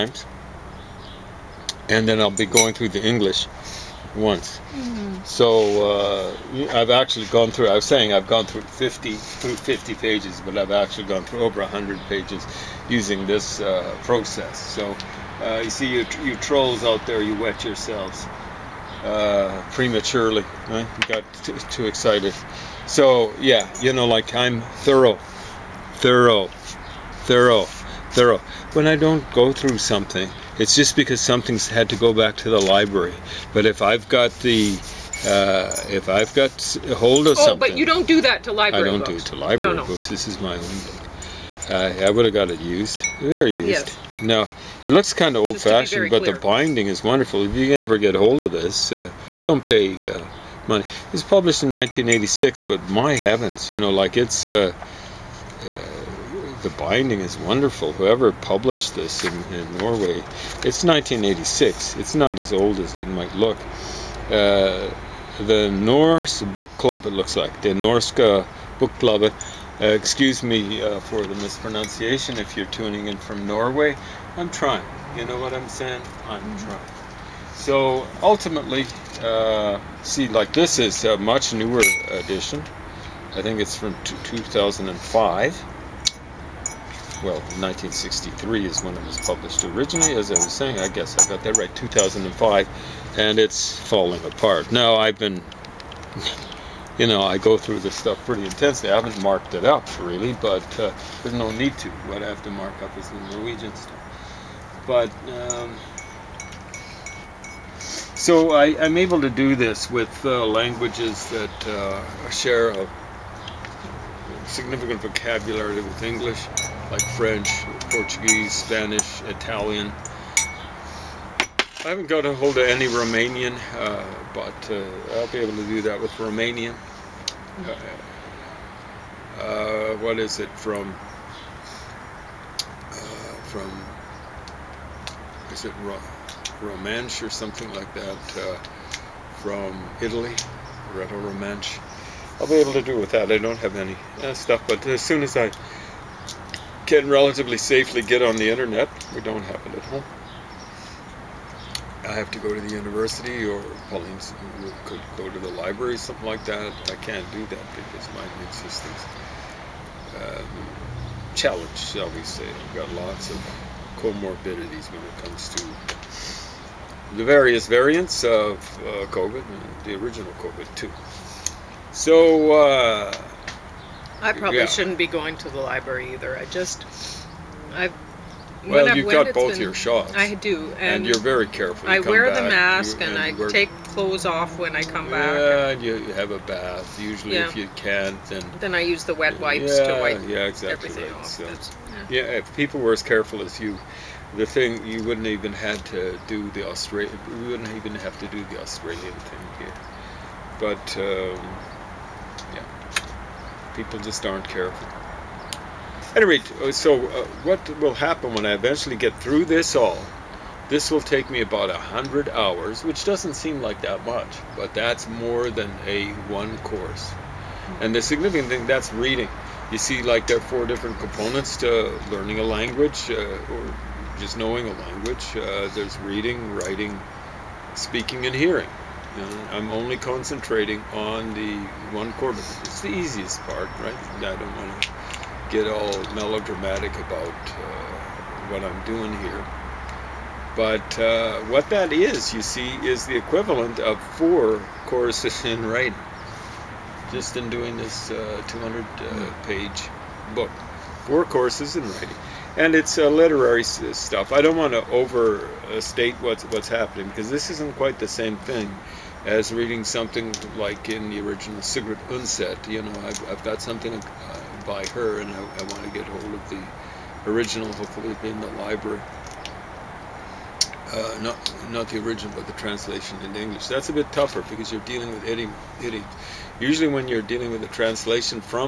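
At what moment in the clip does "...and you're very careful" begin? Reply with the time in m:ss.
3:00.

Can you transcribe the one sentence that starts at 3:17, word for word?
We wouldn't even have to do the Australian thing here, but.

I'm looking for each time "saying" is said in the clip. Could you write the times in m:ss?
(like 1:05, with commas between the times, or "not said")
0:07, 1:15, 1:30.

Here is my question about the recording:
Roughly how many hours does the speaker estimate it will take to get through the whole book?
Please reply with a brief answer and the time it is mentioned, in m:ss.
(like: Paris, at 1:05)
100, at 3:31.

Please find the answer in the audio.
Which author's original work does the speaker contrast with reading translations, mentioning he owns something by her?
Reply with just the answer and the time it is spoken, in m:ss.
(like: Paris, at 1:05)
Sigrid Undset, at 4:21.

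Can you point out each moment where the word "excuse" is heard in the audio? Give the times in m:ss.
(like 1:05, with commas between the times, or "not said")
1:09.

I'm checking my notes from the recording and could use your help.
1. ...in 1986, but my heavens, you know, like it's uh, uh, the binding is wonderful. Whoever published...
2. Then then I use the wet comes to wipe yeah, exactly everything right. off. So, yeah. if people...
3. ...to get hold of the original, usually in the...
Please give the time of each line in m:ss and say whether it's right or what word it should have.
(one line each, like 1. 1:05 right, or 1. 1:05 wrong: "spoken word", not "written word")
1. 0:51 right
2. 3:08 wrong: "wipes", not "comes"
3. 4:25 wrong: "hopefully", not "usually".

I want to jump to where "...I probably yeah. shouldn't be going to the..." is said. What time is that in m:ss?
2:54.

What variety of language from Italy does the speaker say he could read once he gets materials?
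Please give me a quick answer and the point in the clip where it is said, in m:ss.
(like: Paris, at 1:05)
Rhaeto Romance, at 2:20.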